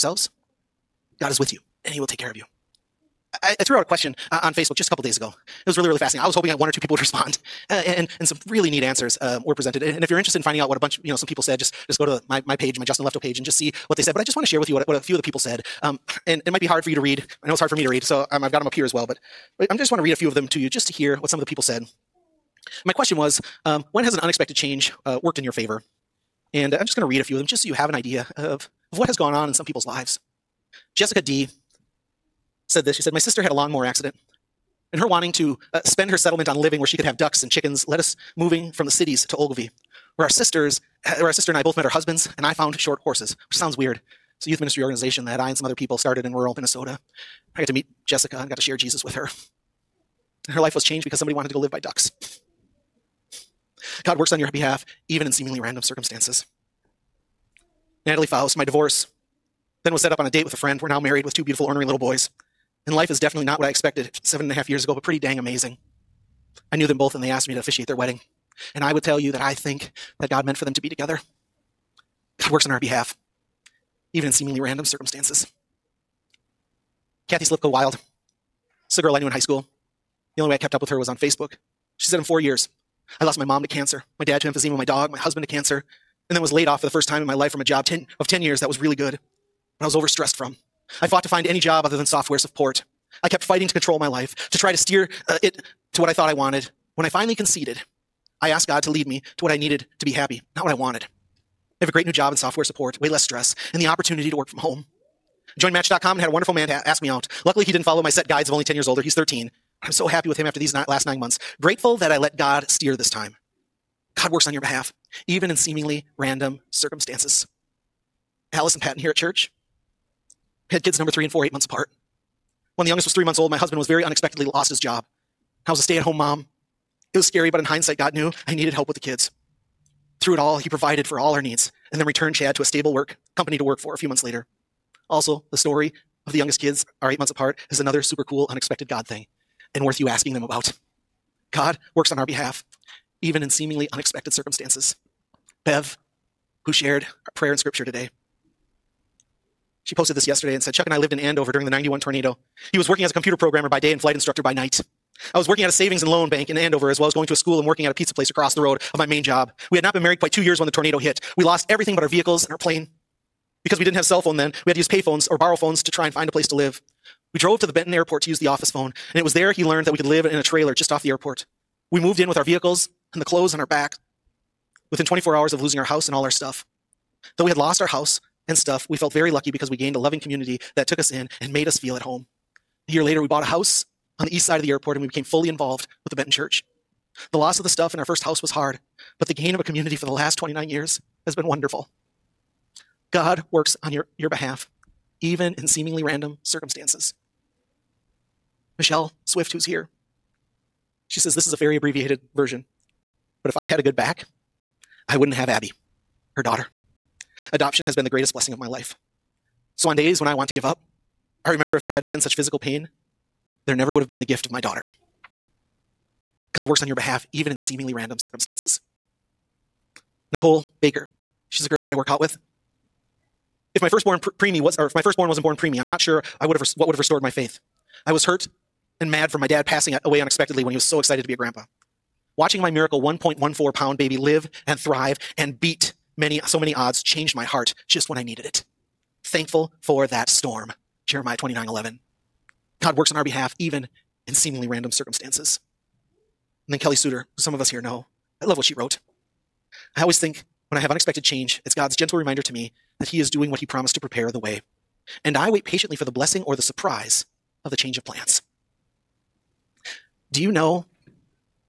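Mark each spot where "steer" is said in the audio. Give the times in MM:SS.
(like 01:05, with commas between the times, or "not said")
01:34, 01:52.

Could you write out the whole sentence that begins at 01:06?
I knew them both and they asked me to officiate their wedding.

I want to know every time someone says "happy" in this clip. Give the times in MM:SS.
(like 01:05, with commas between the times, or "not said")
01:40, 01:50.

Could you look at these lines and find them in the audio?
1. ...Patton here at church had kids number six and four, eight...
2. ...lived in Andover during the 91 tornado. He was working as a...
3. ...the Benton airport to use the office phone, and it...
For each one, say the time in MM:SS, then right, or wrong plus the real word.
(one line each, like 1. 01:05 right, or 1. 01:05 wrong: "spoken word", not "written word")
1. 01:58 wrong: "three", not "six"
2. 02:30 right
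3. 02:47 right.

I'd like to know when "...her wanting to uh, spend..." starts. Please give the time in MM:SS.
00:34.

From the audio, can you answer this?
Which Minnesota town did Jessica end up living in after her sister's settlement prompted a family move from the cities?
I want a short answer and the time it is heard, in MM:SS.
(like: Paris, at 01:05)
Ogilvie, at 00:39.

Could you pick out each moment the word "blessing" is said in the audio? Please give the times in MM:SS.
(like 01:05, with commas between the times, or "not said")
03:28, 04:16.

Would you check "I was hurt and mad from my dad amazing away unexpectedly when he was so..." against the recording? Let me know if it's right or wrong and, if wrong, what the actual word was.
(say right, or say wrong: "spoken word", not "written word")
wrong: "passing", not "amazing".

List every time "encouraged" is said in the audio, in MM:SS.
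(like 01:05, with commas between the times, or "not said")
not said.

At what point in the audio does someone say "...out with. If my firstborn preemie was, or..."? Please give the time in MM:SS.
03:42.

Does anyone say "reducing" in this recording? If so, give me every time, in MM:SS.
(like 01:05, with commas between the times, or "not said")
not said.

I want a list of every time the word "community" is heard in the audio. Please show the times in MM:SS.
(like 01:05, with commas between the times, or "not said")
03:00, 03:09.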